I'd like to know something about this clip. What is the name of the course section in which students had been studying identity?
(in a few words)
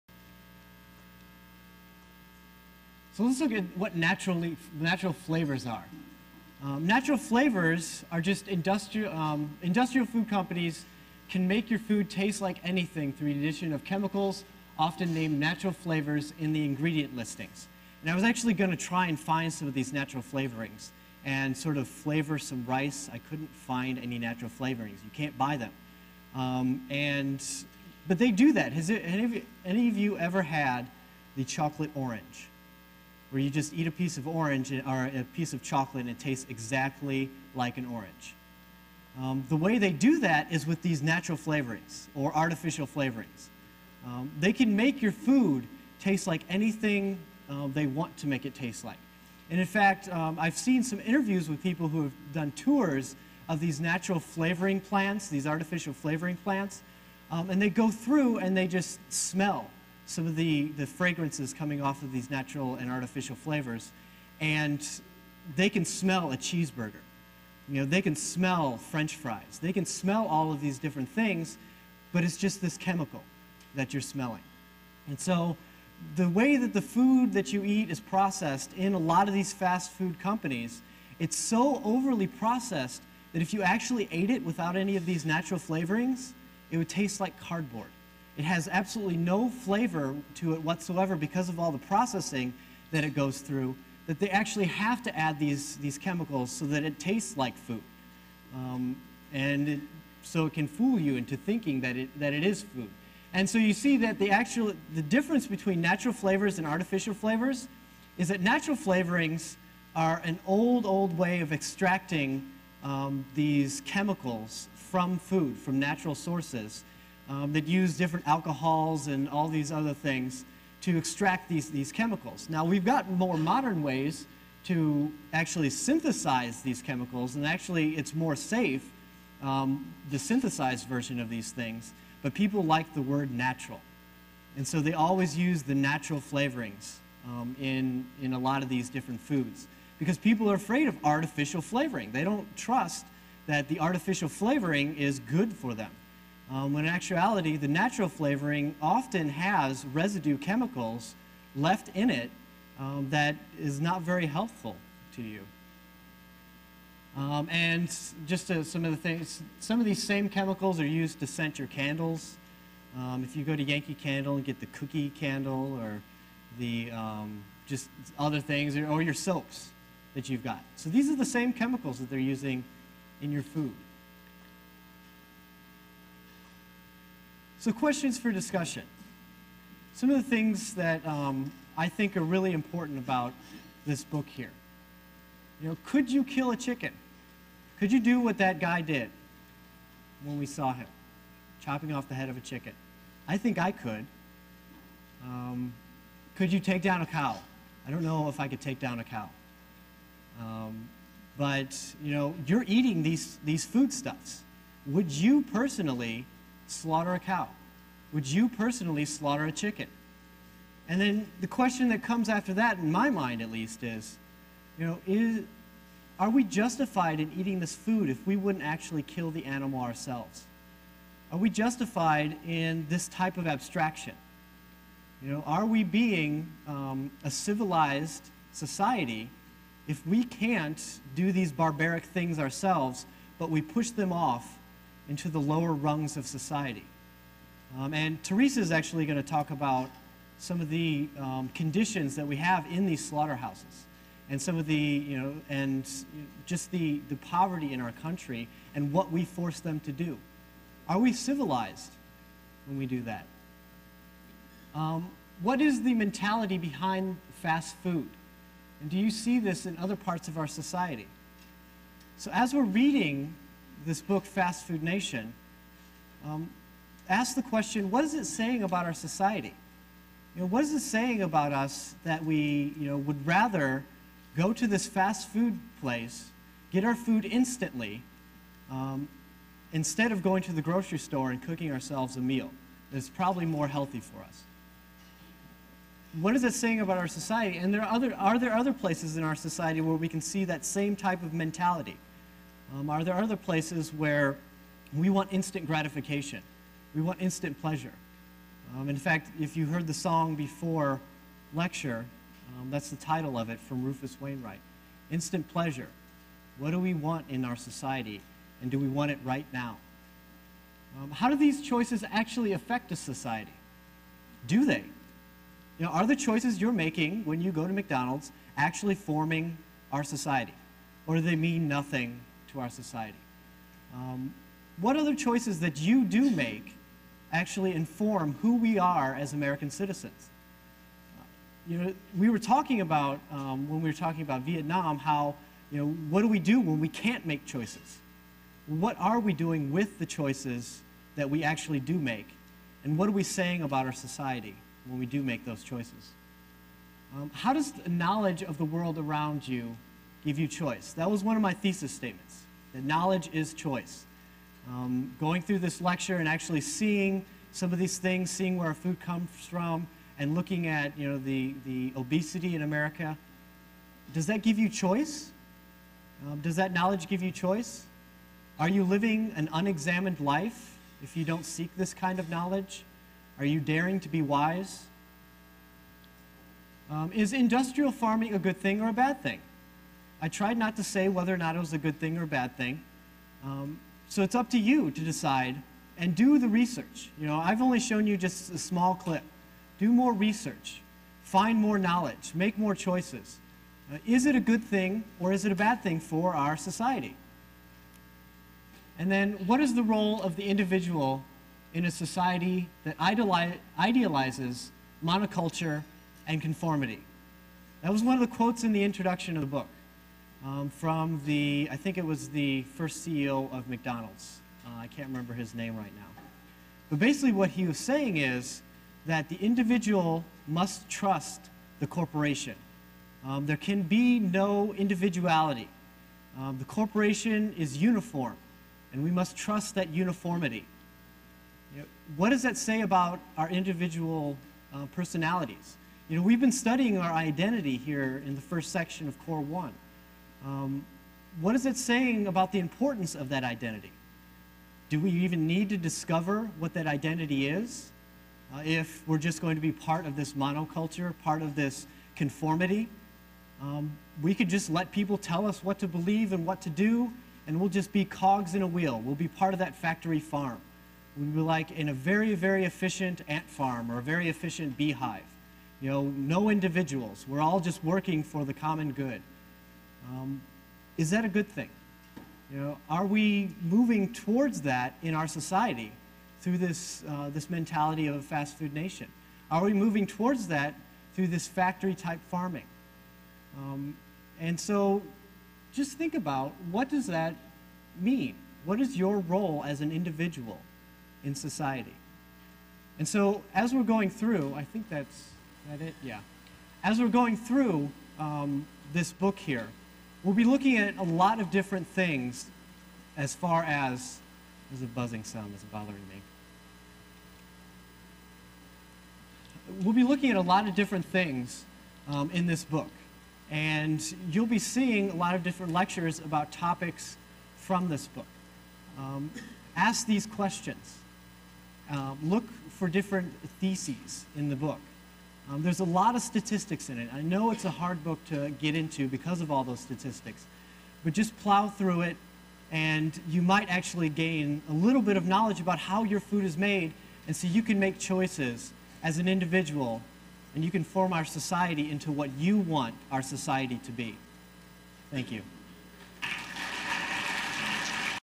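Core 1.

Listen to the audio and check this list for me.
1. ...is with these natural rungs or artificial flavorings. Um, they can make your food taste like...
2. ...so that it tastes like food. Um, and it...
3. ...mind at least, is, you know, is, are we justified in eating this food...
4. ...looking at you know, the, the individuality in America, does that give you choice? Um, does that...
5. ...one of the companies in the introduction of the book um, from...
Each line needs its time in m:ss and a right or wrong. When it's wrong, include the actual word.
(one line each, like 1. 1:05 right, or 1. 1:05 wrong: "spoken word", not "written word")
1. 0:40 wrong: "flavorings", not "rungs"
2. 1:36 right
3. 3:33 right
4. 6:00 wrong: "obesity", not "individuality"
5. 6:48 wrong: "quotes", not "companies".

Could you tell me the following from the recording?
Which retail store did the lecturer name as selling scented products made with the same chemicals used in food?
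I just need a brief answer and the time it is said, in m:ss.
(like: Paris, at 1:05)
Yankee Candle, at 2:43.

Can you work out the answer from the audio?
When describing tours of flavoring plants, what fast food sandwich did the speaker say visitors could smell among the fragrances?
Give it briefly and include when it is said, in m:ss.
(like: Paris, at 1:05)
cheeseburger, at 1:06.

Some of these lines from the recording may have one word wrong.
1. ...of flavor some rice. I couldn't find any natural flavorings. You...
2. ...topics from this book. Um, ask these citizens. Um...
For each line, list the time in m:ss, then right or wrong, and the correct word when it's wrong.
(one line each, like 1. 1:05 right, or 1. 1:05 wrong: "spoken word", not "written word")
1. 0:21 right
2. 8:36 wrong: "questions", not "citizens".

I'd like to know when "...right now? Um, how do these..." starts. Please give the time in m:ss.
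5:09.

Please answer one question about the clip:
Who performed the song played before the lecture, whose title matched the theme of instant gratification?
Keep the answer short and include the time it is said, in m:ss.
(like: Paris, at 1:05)
Rufus Wainwright, at 5:03.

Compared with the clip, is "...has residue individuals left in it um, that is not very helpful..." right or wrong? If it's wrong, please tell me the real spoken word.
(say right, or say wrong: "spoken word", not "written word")
wrong: "chemicals", not "individuals".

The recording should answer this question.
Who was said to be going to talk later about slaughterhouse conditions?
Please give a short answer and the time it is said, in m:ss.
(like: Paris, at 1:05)
Teresa, at 3:58.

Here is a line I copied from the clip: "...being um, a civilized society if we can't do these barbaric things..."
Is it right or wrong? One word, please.
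right.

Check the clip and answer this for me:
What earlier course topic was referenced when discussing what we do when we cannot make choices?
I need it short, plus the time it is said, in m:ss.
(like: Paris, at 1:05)
Vietnam, at 5:34.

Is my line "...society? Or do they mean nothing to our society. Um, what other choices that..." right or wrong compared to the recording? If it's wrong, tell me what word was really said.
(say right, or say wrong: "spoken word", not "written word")
right.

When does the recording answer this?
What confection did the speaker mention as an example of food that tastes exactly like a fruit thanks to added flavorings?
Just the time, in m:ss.
0:31.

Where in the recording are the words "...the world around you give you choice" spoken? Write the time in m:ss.
5:48.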